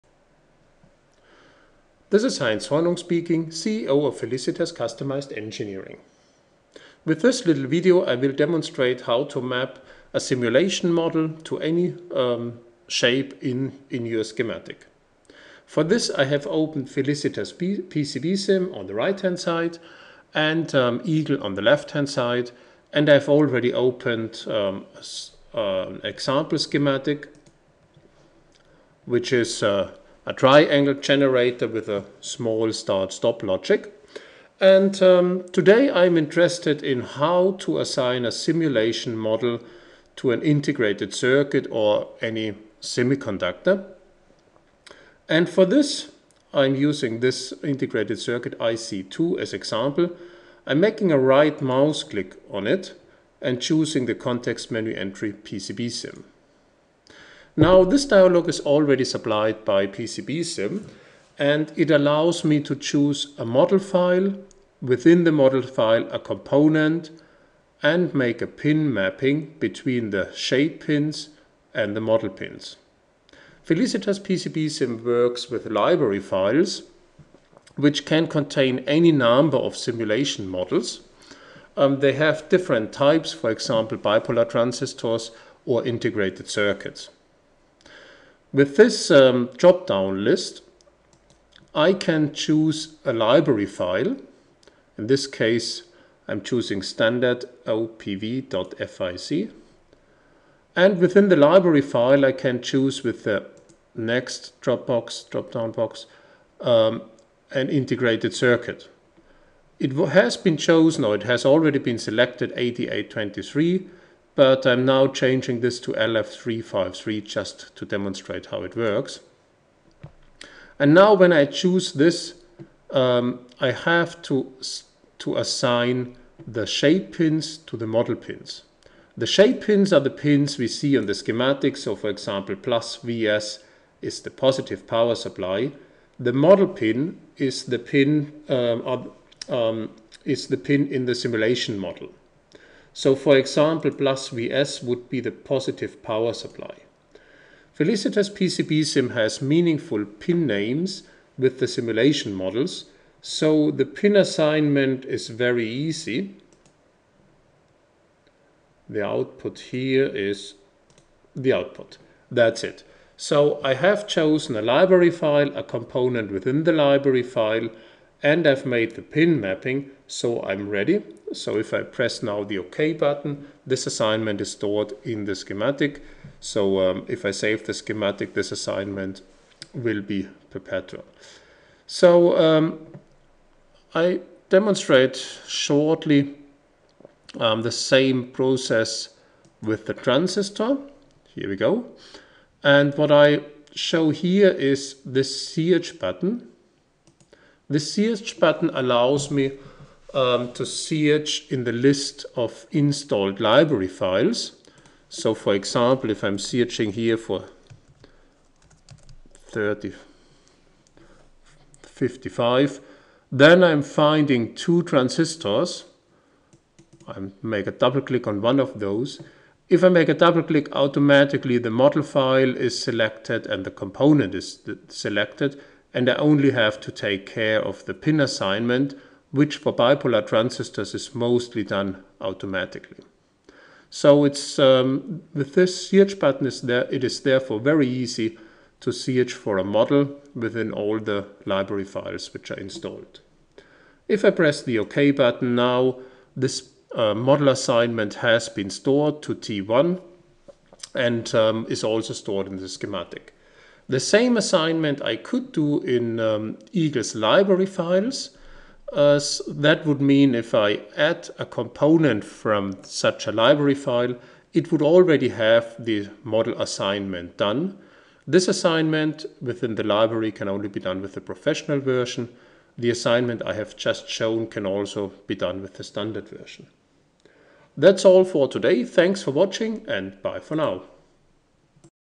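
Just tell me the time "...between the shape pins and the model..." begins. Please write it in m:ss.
1:09.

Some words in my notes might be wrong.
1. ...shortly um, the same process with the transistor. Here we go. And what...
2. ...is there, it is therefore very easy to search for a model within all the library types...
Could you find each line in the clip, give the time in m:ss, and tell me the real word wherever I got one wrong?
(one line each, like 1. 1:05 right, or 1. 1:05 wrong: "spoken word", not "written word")
1. 3:05 right
2. 3:56 wrong: "files", not "types".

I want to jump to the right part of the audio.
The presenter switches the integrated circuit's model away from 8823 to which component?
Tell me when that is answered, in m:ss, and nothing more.
1:55.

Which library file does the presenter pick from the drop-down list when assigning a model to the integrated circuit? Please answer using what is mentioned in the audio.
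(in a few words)
standard opv.fic.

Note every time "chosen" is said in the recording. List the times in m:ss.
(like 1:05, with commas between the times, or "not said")
1:50, 2:44.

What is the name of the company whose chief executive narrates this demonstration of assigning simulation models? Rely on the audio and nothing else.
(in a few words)
Felicitas Customized Engineering.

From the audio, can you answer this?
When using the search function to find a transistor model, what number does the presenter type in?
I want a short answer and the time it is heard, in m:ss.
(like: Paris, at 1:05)
3055, at 3:29.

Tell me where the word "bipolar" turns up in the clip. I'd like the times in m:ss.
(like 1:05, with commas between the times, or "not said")
1:23, 3:49.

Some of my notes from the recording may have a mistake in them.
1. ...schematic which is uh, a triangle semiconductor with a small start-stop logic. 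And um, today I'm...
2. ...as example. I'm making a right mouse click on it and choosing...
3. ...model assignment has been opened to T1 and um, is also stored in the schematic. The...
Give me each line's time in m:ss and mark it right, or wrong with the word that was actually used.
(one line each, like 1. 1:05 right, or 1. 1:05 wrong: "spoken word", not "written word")
1. 0:26 wrong: "generator", not "semiconductor"
2. 0:49 right
3. 4:07 wrong: "stored", not "opened".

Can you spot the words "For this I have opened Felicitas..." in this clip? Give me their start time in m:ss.
0:15.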